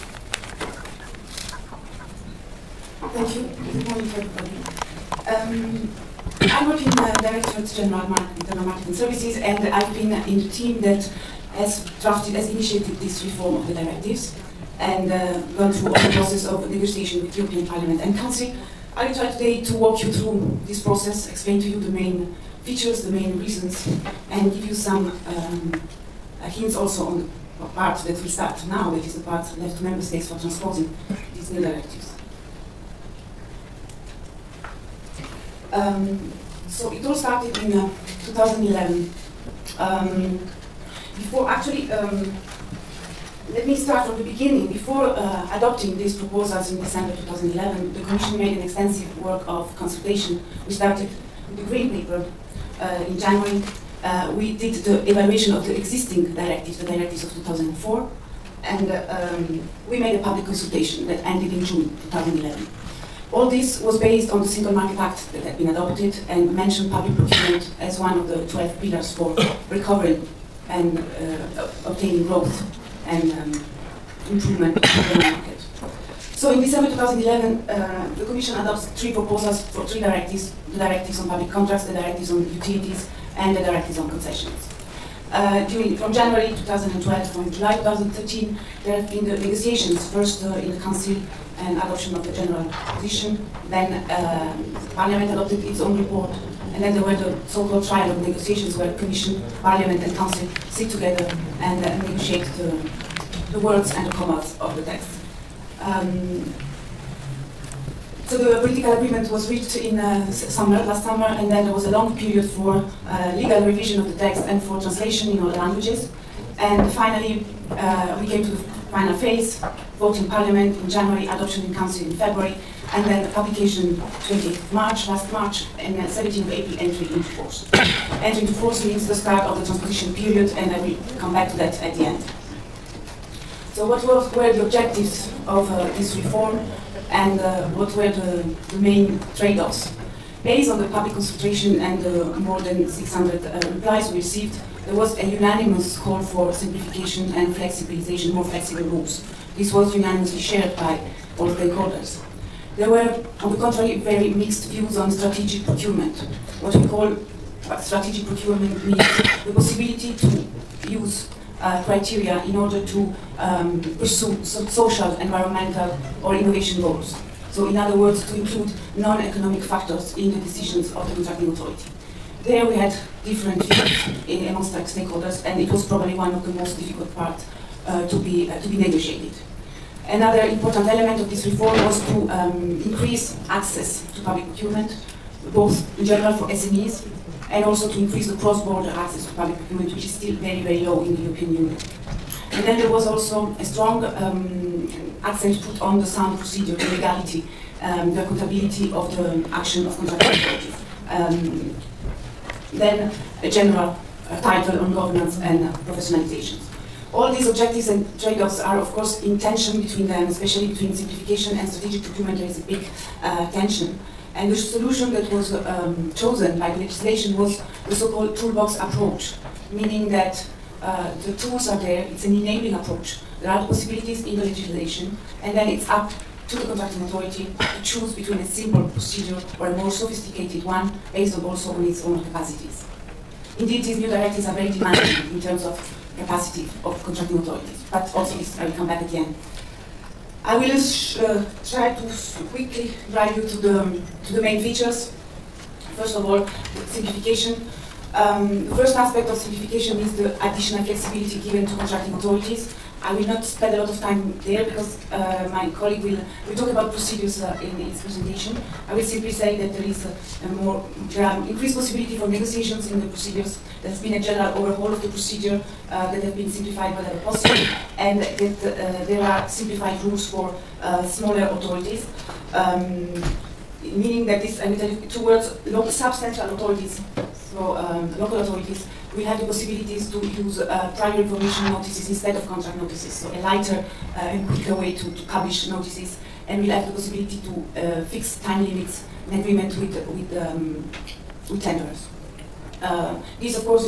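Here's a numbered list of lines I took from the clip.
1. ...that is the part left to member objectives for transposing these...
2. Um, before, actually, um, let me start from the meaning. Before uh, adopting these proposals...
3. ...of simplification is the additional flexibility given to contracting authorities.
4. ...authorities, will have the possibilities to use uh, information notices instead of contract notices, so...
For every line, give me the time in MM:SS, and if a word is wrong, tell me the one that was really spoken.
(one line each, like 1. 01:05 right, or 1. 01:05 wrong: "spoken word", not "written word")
1. 00:28 wrong: "states", not "objectives"
2. 00:39 wrong: "beginning", not "meaning"
3. 04:09 right
4. 04:38 right.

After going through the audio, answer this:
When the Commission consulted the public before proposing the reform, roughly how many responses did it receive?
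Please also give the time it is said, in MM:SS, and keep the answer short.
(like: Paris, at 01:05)
more than 600, at 02:22.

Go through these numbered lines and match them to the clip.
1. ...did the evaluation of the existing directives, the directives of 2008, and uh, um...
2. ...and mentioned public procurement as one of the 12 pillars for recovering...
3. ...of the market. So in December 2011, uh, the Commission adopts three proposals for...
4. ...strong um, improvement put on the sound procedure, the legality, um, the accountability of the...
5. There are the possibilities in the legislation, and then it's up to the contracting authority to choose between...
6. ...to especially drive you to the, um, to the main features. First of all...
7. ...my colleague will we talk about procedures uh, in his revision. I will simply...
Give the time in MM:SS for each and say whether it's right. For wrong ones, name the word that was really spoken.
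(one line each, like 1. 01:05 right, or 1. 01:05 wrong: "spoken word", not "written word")
1. 00:54 wrong: "2004", not "2008"
2. 01:06 right
3. 01:14 right
4. 03:13 wrong: "accent", not "improvement"
5. 03:43 right
6. 04:01 wrong: "quickly", not "especially"
7. 04:15 wrong: "presentation", not "revision".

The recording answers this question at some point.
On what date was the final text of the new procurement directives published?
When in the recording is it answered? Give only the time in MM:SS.
02:04.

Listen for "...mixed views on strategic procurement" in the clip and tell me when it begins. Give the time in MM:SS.
02:34.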